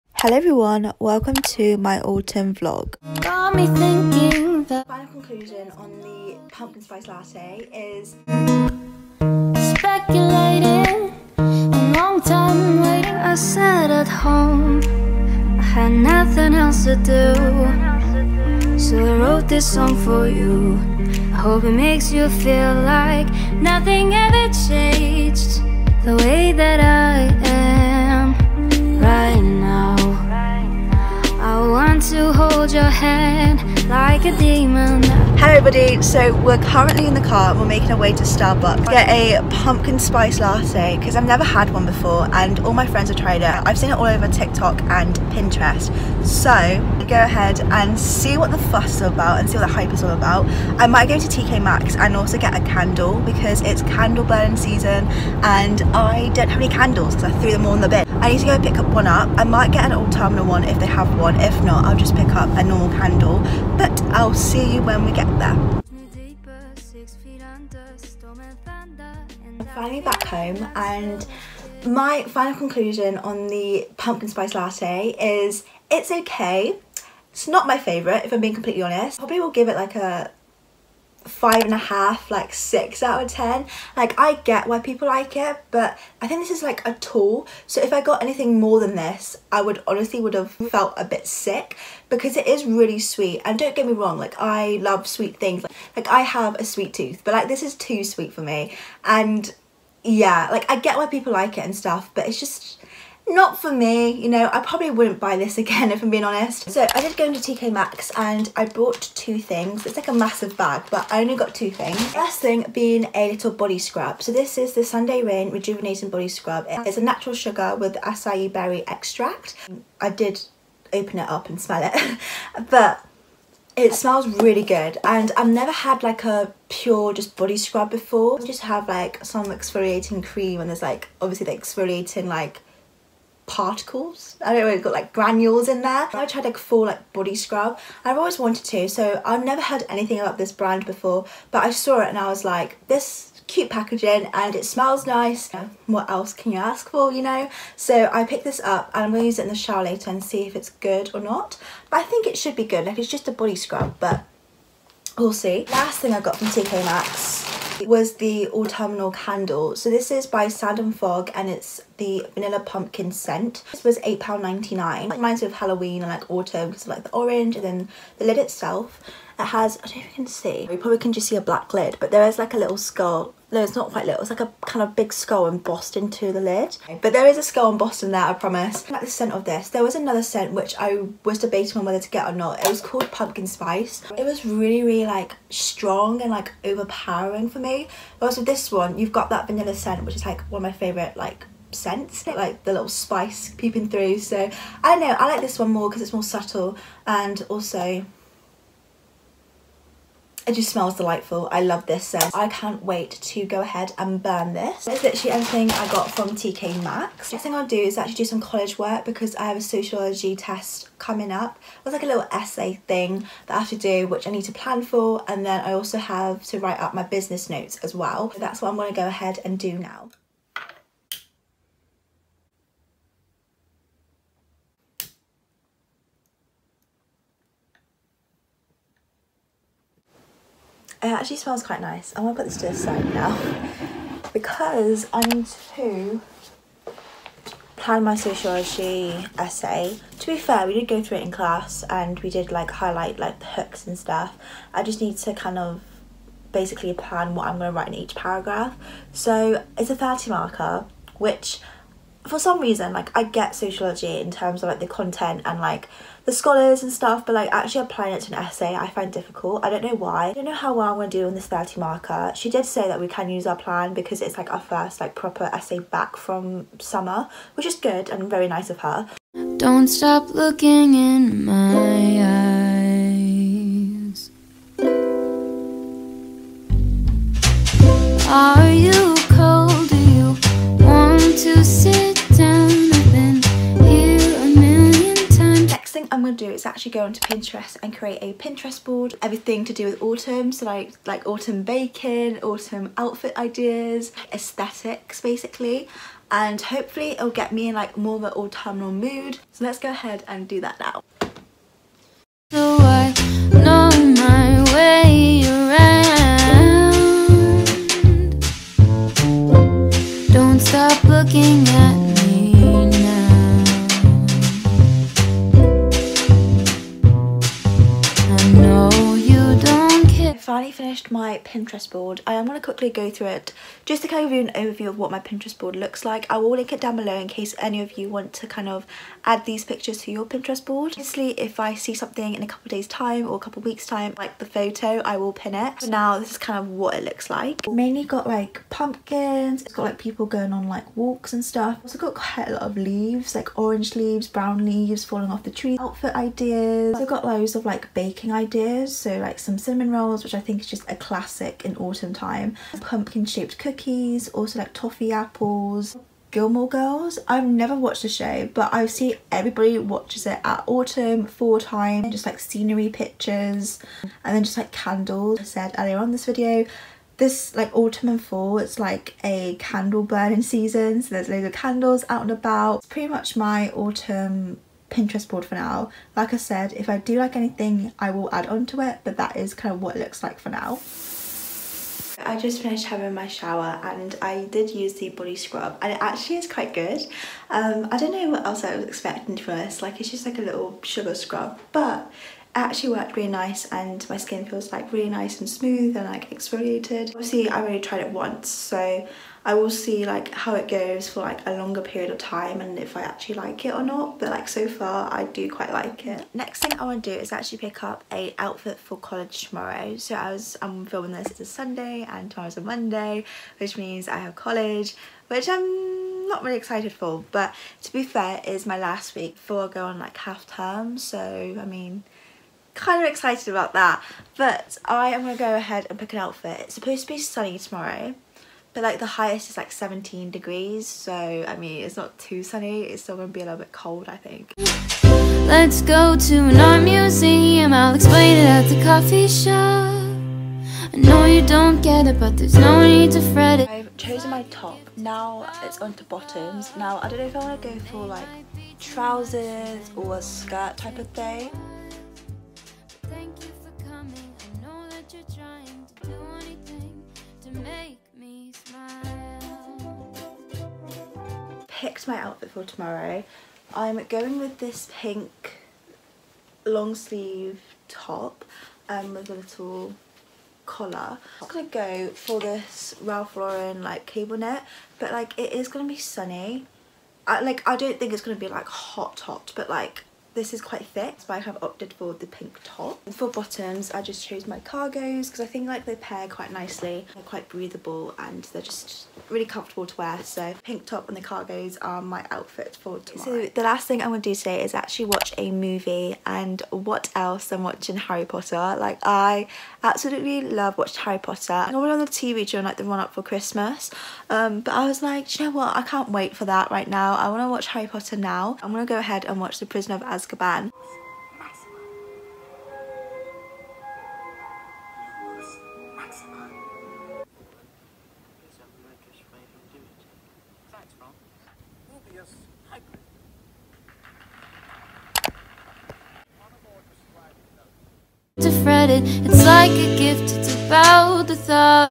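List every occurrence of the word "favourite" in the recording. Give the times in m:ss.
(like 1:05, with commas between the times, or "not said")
1:17, 3:10.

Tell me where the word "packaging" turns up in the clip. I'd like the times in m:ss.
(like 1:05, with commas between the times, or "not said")
2:23.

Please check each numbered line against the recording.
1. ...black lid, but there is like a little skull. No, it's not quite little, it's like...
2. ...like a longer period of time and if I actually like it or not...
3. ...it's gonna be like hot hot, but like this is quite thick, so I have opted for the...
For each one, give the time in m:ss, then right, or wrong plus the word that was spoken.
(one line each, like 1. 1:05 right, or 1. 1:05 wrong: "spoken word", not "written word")
1. 2:51 right
2. 6:41 right
3. 7:58 right.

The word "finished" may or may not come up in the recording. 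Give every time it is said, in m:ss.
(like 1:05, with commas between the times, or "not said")
5:20, 6:22.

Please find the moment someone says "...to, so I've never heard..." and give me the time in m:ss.
2:18.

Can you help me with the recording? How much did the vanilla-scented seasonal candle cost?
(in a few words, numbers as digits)
£8.99.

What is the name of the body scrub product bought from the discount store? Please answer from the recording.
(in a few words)
Sunday Rain Rejuvenating Body Scrub.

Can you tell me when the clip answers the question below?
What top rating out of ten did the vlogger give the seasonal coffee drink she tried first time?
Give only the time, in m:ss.
1:22.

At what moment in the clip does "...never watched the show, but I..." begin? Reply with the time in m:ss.
5:57.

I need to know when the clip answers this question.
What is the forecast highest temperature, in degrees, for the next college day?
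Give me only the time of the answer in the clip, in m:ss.
7:09.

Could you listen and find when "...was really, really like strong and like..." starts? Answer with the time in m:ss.
3:04.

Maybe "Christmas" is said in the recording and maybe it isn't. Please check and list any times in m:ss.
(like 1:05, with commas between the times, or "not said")
8:23.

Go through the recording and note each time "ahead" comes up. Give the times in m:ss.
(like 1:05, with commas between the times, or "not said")
0:47, 3:23, 3:39, 4:59, 7:05, 8:28.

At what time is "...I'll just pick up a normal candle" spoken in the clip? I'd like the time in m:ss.
1:01.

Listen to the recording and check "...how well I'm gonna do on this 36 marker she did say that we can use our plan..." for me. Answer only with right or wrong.
wrong.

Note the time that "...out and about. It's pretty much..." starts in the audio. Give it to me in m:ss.
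6:12.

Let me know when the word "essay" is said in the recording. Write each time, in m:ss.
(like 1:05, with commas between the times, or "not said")
3:32, 3:59, 4:18, 4:25.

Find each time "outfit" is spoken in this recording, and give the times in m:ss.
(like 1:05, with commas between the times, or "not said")
4:52, 5:45, 6:48, 7:06, 7:42, 8:12.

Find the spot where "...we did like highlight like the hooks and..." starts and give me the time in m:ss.
4:02.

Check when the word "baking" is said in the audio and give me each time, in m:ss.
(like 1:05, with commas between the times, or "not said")
4:51, 5:47.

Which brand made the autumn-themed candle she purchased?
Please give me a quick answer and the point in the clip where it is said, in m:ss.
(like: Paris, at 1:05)
Sand and Fog, at 2:40.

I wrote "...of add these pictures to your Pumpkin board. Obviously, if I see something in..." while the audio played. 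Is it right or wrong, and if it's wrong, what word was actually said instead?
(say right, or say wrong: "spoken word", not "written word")
wrong: "Pinterest", not "Pumpkin".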